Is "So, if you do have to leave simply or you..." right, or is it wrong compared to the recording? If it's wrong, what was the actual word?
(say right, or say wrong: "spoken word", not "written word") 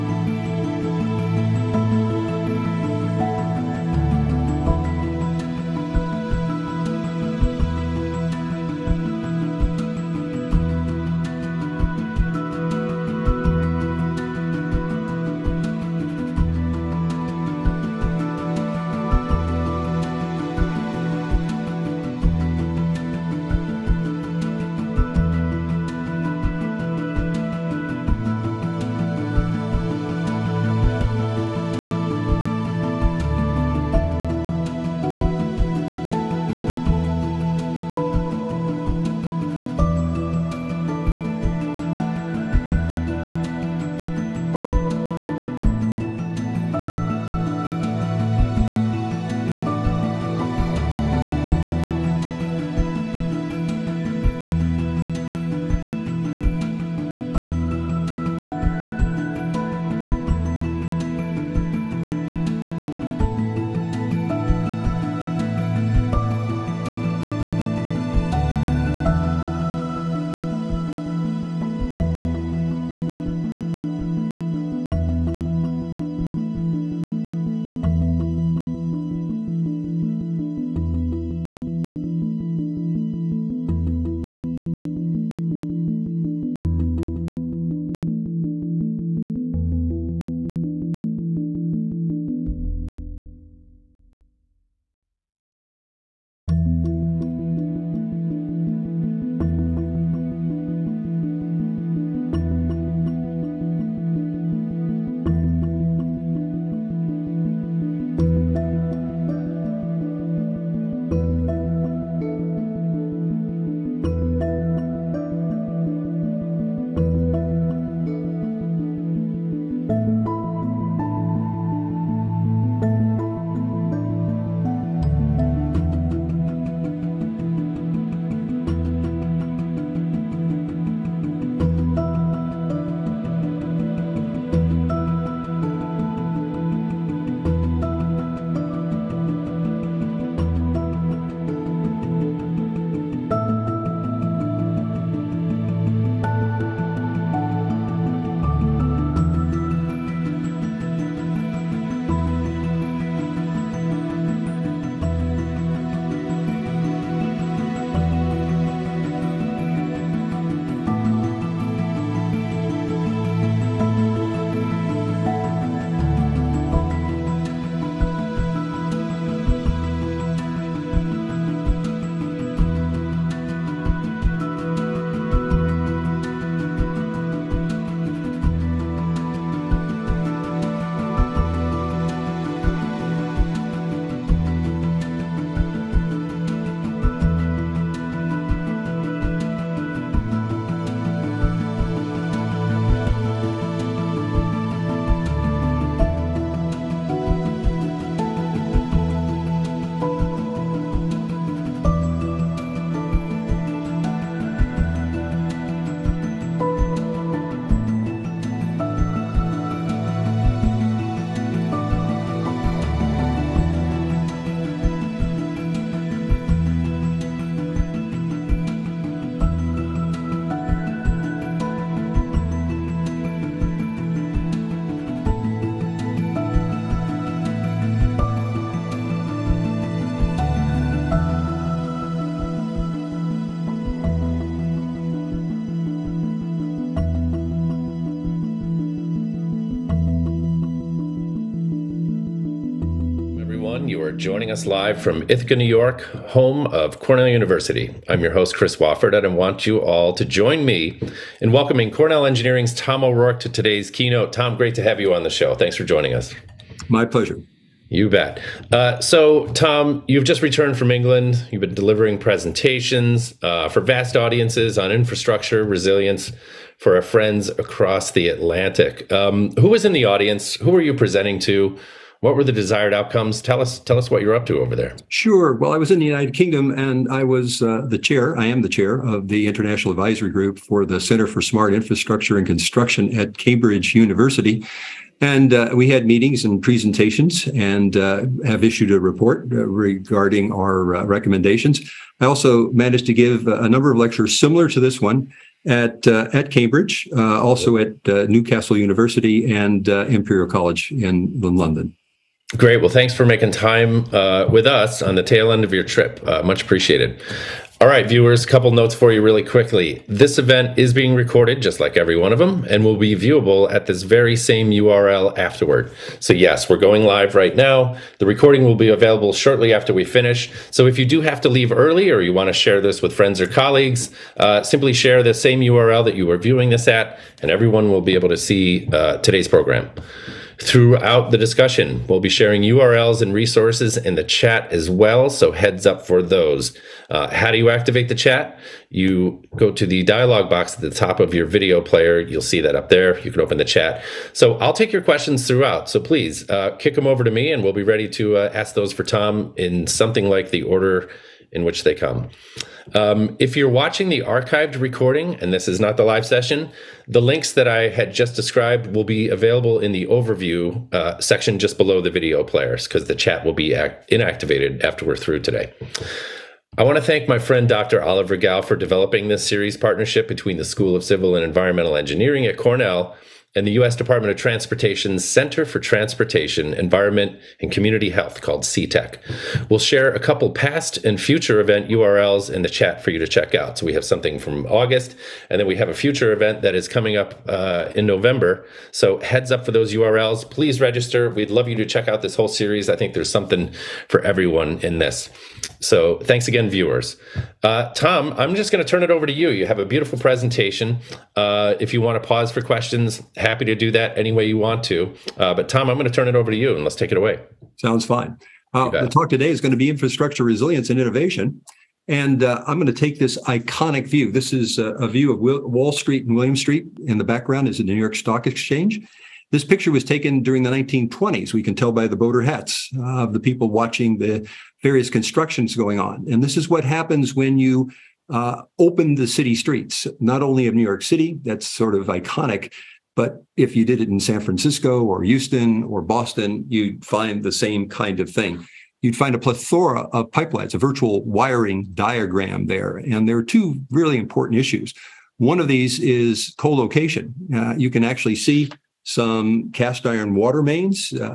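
wrong: "early", not "simply".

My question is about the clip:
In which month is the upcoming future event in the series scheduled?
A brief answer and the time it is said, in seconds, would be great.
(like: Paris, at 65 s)
November, at 388 s.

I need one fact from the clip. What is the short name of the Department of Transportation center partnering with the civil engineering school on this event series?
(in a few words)
CTECH.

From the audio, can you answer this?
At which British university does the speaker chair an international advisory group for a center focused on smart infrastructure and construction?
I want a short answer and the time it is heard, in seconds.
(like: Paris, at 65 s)
Cambridge University, at 283 s.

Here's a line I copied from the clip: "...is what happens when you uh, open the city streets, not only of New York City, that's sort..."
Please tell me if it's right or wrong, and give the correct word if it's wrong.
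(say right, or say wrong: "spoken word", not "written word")
right.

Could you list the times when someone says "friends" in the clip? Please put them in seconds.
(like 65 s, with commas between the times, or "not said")
267 s, 323 s, 367 s.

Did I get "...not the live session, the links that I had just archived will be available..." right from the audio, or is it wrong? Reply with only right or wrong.
wrong.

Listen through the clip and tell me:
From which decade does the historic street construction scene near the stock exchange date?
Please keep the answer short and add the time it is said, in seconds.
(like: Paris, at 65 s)
1920s, at 420 s.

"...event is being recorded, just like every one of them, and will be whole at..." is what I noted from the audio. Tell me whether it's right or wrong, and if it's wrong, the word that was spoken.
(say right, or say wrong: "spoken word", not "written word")
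wrong: "viewable", not "whole".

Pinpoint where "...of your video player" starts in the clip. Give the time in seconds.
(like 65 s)
341 s.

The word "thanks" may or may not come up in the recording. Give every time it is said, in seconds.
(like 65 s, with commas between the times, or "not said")
255 s, 302 s, 367 s, 396 s.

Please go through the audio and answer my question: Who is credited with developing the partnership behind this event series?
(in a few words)
Oliver Gao.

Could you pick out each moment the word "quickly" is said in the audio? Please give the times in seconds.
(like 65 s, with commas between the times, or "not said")
309 s.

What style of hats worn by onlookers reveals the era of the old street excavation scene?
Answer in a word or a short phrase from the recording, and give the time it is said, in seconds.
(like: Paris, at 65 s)
boater hats, at 422 s.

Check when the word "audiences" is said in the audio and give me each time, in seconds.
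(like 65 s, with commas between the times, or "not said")
264 s, 270 s.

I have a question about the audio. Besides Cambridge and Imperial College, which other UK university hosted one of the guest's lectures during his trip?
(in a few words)
Newcastle University.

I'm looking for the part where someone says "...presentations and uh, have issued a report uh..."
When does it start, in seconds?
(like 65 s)
286 s.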